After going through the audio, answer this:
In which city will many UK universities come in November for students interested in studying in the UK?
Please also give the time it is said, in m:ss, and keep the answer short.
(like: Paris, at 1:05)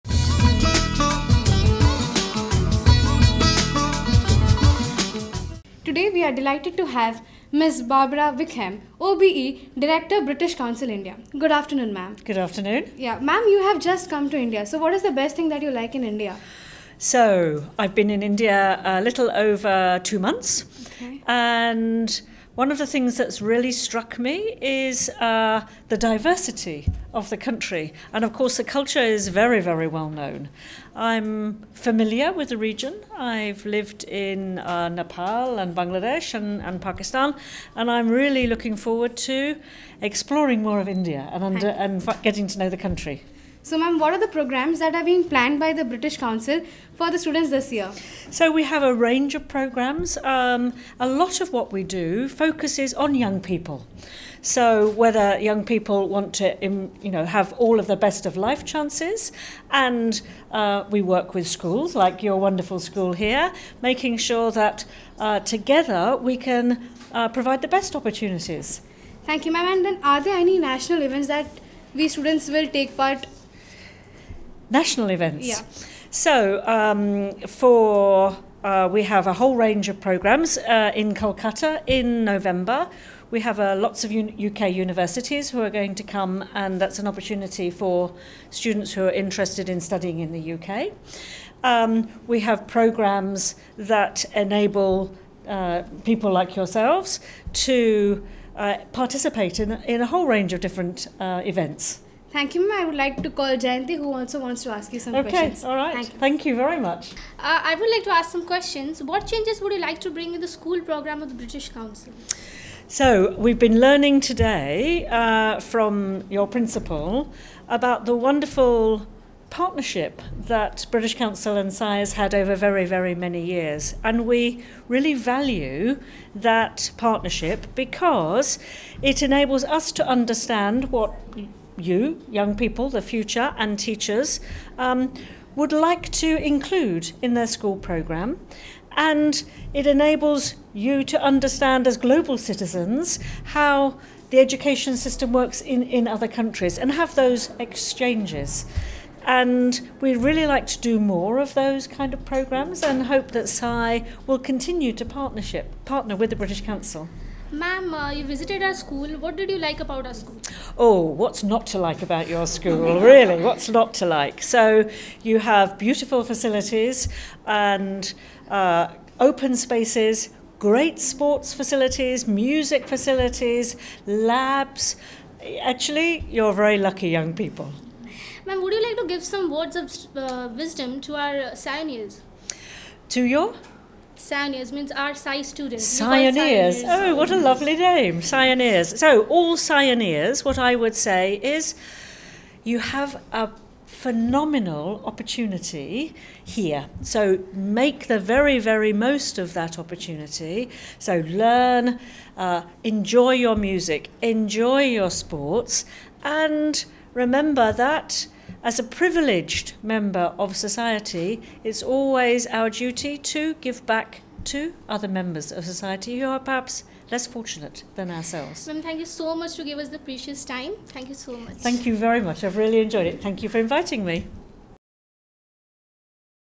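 Kolkata, at 1:21.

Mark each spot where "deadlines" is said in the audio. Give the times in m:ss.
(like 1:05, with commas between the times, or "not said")
not said.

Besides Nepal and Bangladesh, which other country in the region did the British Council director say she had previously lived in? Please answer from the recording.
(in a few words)
Pakistan.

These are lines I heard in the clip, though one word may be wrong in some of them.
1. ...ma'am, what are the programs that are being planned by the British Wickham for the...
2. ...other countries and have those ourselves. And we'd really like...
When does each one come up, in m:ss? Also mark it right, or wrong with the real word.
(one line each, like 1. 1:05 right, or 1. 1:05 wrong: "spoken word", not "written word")
1. 0:43 wrong: "Council", not "Wickham"
2. 2:26 wrong: "exchanges", not "ourselves".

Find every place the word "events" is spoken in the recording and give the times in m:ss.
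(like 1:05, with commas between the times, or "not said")
1:11, 1:15, 1:41.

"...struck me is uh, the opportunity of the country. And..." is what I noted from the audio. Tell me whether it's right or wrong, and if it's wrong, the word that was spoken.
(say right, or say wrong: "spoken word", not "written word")
wrong: "diversity", not "opportunity".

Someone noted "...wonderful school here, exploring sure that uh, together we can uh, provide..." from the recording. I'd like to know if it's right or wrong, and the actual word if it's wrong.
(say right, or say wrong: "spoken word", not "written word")
wrong: "making", not "exploring".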